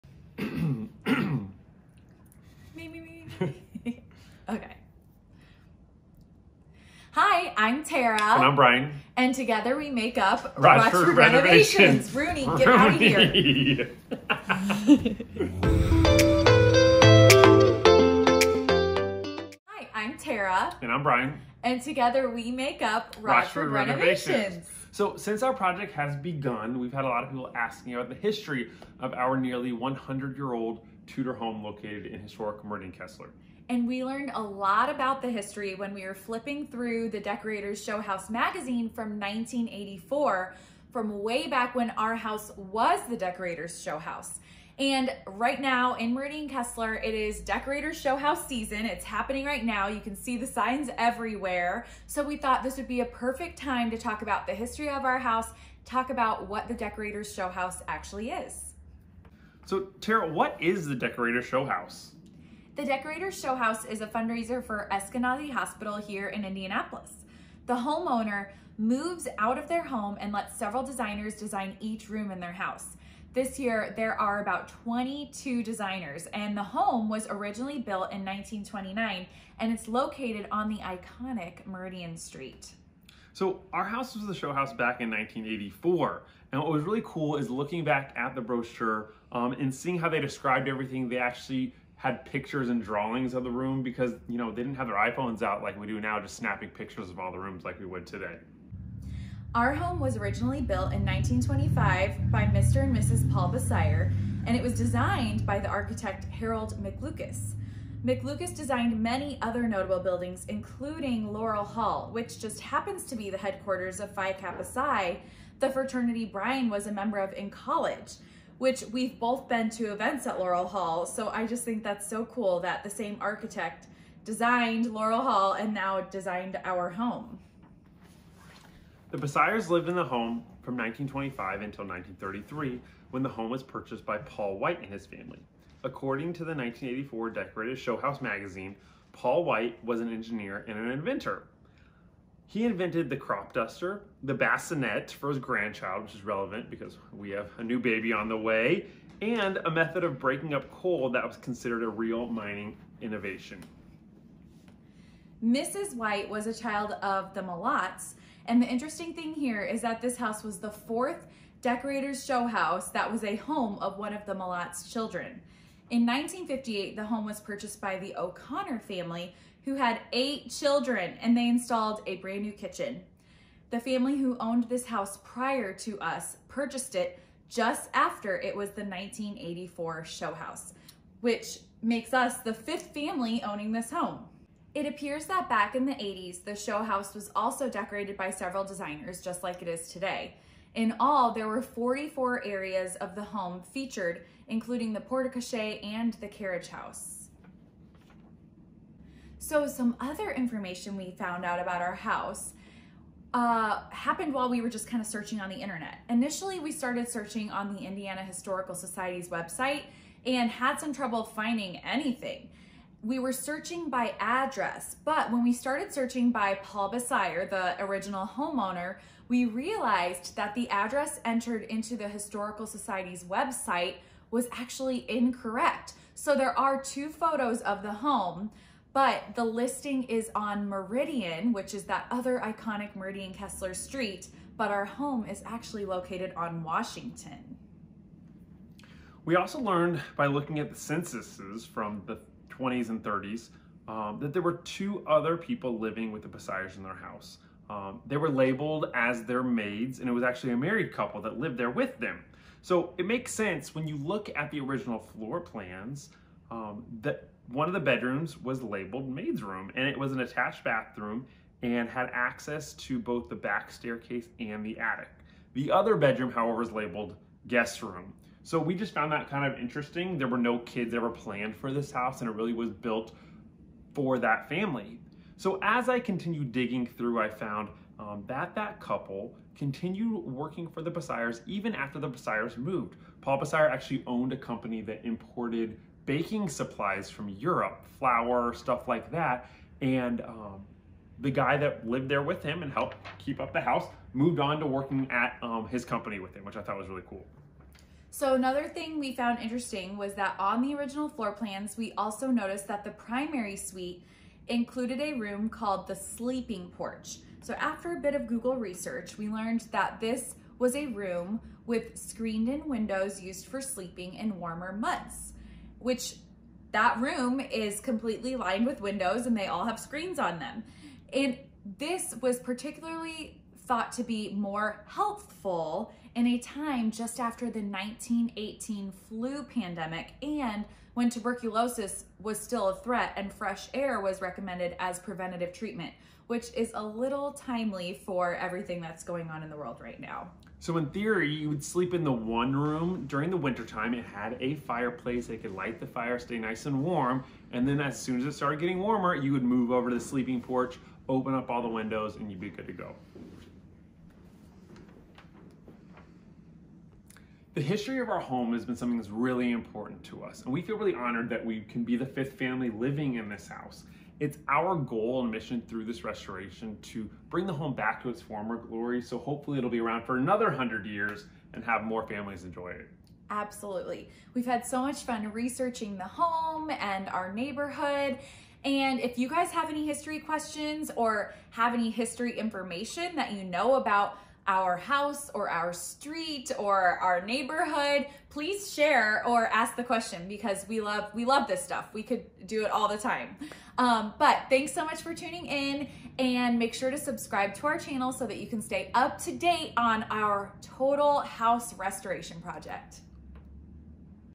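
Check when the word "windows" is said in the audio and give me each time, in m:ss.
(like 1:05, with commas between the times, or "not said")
5:12, 5:18, 5:51.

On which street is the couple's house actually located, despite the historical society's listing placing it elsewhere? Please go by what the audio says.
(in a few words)
Washington.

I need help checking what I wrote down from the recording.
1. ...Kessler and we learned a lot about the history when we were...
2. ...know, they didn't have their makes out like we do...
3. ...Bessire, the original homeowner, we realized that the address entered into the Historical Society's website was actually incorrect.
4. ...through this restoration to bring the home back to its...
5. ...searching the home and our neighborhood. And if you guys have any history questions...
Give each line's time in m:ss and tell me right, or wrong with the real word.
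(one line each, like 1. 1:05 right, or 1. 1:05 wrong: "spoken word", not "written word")
1. 0:32 right
2. 1:34 wrong: "iPhones", not "makes"
3. 3:36 right
4. 6:05 right
5. 6:15 wrong: "researching", not "searching".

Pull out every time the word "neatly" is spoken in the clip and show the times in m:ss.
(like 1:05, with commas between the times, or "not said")
not said.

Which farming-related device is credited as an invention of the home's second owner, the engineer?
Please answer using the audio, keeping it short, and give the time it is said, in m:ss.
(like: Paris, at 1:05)
crop duster, at 2:23.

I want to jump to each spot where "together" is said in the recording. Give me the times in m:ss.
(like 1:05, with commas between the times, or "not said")
0:09, 0:21.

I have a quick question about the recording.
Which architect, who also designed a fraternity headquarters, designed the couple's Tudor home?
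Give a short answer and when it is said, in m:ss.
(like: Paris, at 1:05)
Harold McLucas, at 1:46.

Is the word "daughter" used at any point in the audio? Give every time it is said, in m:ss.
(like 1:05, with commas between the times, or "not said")
not said.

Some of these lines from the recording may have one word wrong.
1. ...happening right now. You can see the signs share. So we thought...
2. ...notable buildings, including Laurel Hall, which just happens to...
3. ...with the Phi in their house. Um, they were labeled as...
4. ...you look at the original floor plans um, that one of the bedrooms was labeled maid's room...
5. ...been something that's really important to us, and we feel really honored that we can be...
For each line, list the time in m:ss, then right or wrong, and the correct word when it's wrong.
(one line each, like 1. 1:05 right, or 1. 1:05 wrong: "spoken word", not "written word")
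1. 0:49 wrong: "everywhere", not "share"
2. 1:49 right
3. 4:06 wrong: "Bessires", not "Phi"
4. 4:13 right
5. 5:58 right.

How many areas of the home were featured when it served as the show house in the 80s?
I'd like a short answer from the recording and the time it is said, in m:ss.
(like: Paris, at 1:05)
44, at 3:11.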